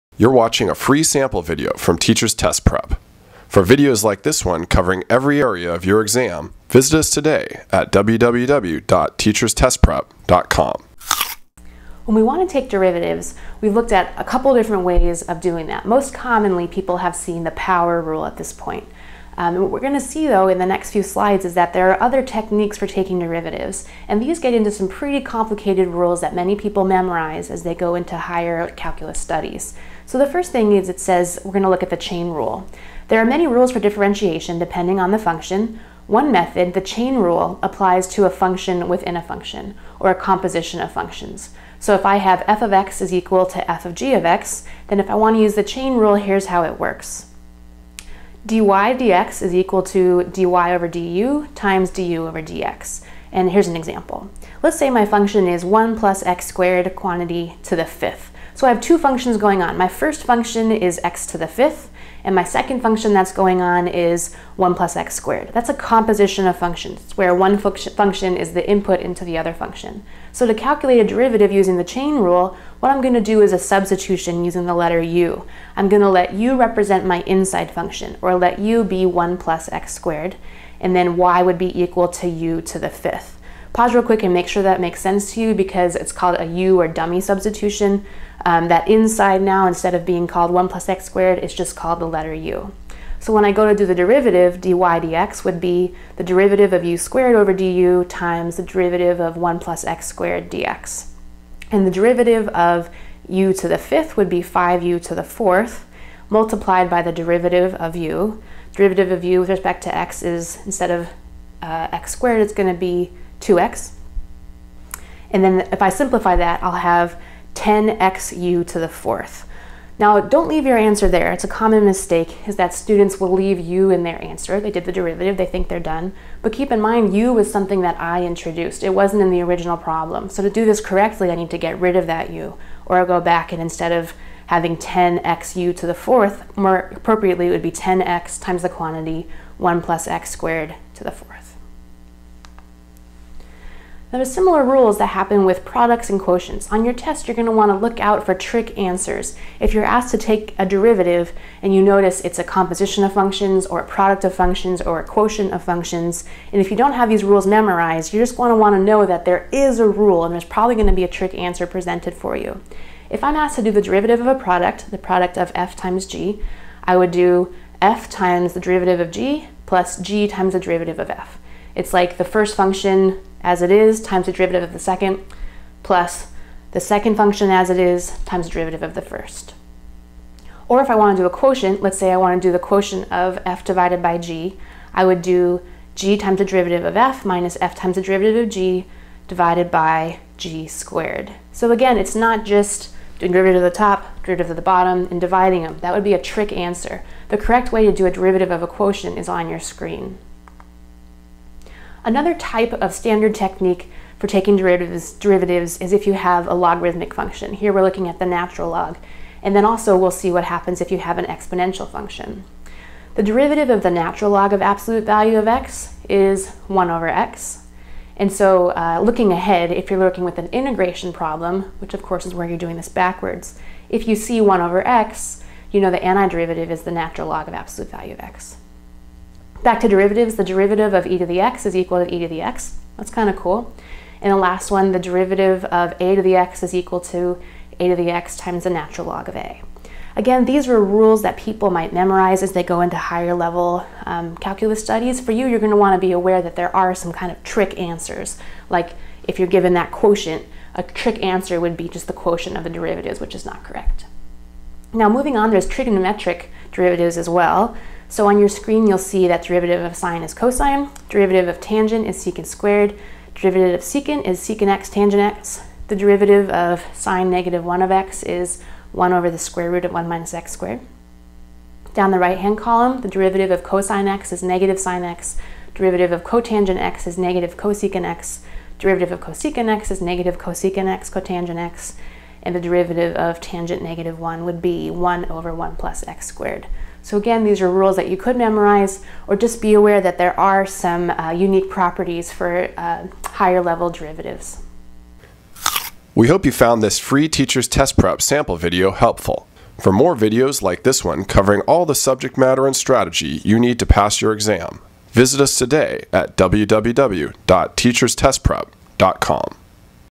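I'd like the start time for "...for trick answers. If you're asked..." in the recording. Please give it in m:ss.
2:28.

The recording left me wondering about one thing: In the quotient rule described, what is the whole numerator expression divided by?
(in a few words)
g squared.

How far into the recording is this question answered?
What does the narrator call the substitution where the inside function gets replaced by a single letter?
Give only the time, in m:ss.
1:26.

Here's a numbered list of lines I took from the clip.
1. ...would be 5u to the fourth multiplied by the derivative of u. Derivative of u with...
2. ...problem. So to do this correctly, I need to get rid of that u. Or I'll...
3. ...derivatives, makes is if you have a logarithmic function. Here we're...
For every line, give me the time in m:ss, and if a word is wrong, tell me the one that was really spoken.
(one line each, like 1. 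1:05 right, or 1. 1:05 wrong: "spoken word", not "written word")
1. 1:44 right
2. 2:09 right
3. 3:24 wrong: "derivatives", not "makes".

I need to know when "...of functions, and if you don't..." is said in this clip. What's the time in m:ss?
2:35.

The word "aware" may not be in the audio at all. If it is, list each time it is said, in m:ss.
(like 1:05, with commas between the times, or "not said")
4:06, 4:49.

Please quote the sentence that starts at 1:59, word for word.
Now, don't leave your answer there.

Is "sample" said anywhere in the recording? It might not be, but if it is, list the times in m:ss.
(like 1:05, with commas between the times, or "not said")
0:01, 4:58.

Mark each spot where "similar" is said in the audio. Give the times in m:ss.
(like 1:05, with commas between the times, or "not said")
2:24.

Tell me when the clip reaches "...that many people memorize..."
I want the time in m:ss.
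0:26.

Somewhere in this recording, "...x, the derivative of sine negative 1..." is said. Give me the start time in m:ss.
4:25.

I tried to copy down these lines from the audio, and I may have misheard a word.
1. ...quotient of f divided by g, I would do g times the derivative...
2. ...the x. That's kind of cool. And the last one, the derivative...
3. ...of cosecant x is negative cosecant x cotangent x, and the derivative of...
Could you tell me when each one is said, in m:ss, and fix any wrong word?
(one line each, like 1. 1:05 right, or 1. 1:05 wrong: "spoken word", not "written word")
1. 3:02 right
2. 3:52 right
3. 4:39 right.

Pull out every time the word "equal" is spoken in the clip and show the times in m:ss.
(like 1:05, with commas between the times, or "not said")
0:43, 0:49, 1:21, 3:51, 3:56.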